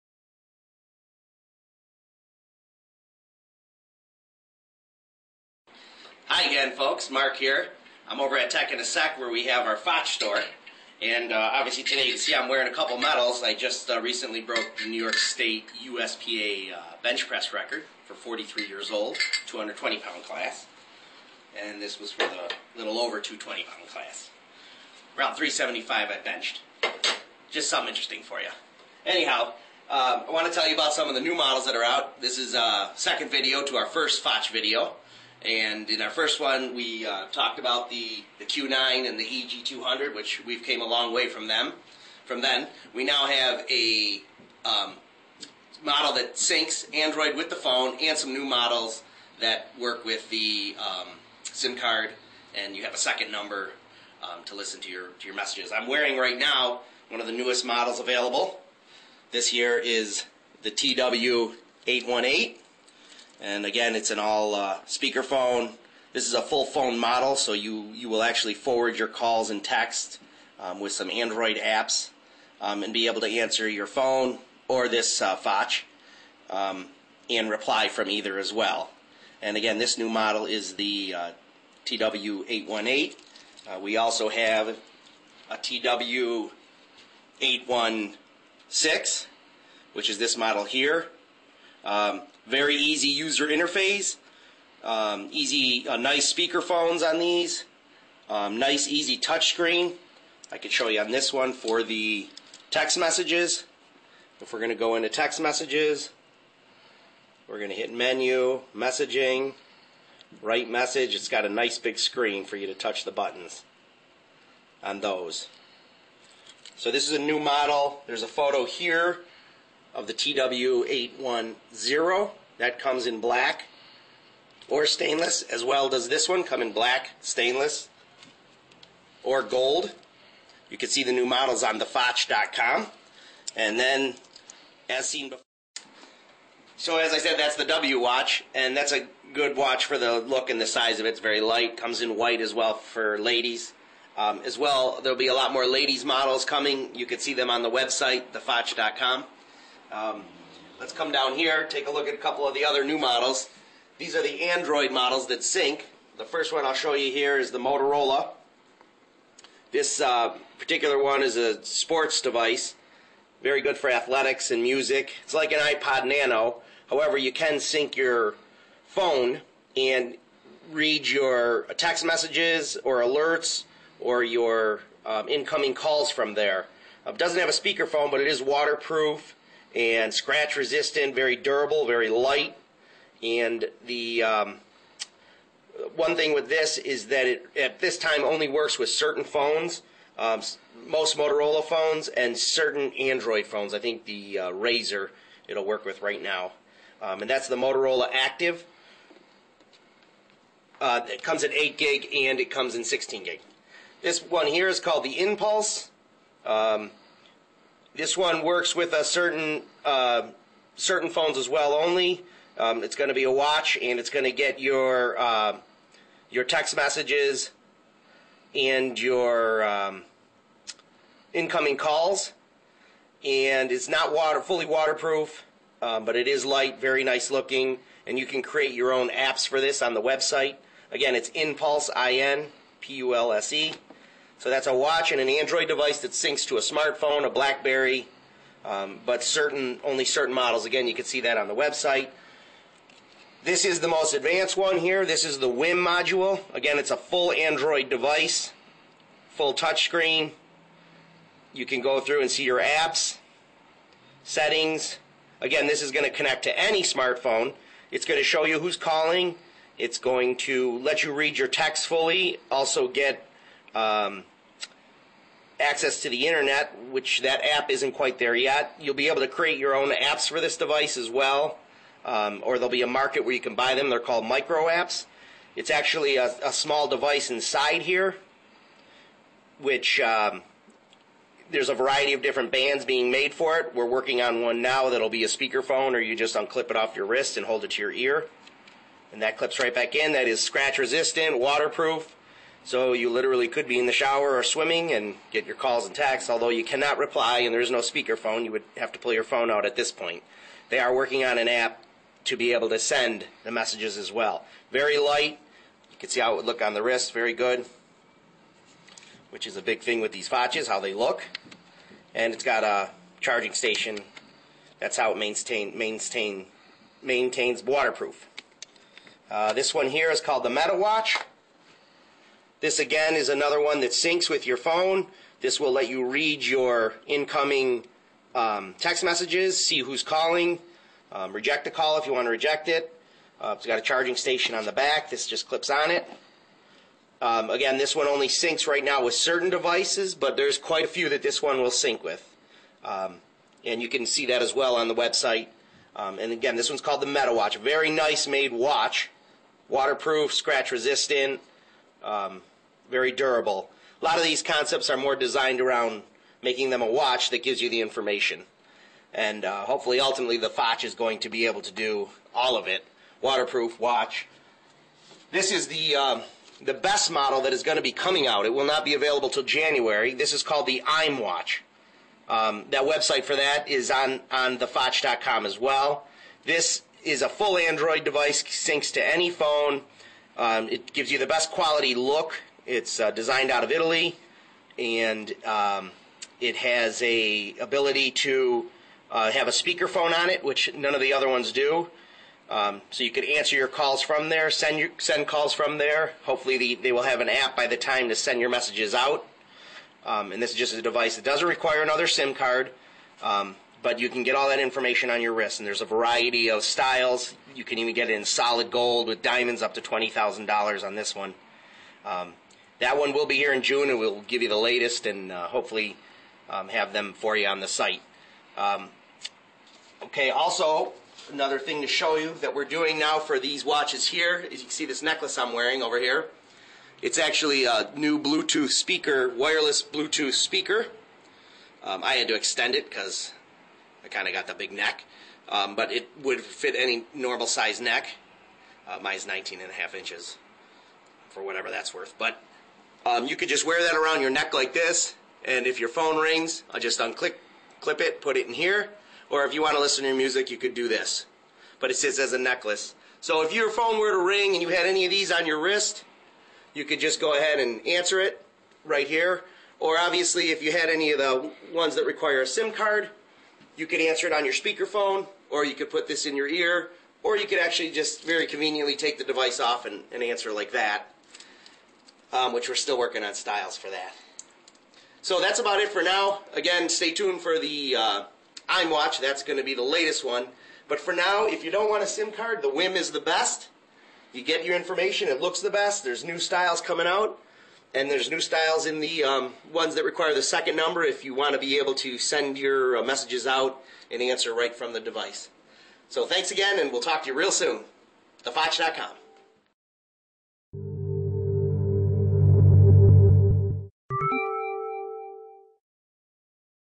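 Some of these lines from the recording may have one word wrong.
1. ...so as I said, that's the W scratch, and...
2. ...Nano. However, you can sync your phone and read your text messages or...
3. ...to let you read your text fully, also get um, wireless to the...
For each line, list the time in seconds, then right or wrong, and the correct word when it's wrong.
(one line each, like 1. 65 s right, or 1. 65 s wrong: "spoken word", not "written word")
1. 136 s wrong: "watch", not "scratch"
2. 166 s right
3. 260 s wrong: "access", not "wireless".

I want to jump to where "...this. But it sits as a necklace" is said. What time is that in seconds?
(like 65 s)
450 s.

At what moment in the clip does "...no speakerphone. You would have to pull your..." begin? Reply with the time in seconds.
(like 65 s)
297 s.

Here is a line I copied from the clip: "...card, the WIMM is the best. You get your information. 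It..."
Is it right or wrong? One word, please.
right.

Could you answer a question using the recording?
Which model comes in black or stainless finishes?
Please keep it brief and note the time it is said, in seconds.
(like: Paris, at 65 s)
TW810, at 120 s.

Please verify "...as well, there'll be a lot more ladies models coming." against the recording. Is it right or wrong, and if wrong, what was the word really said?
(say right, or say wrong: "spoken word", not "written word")
right.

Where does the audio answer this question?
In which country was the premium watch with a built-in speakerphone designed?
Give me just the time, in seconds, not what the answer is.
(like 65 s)
383 s.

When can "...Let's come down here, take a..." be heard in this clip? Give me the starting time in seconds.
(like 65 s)
150 s.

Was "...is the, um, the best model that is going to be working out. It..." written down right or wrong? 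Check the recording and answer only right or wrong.
wrong.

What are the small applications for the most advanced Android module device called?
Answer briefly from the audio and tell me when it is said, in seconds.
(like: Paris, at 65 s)
micro apps, at 274 s.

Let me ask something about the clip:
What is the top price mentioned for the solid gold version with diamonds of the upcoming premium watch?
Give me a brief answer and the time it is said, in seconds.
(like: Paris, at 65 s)
$20,000, at 409 s.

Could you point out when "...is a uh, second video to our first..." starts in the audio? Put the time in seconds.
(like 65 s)
32 s.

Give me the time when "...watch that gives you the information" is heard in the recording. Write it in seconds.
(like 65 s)
356 s.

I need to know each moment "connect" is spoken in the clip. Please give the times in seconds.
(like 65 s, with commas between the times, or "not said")
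256 s.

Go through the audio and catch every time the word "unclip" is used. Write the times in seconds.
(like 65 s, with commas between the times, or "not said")
286 s, 446 s.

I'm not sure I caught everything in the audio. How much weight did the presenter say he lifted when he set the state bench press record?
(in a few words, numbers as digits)
375.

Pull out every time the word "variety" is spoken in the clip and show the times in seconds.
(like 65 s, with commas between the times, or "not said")
281 s, 405 s.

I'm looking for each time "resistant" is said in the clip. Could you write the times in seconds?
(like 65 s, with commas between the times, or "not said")
180 s, 290 s, 350 s.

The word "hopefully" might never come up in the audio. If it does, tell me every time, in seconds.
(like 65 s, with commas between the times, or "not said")
359 s, 396 s, 415 s.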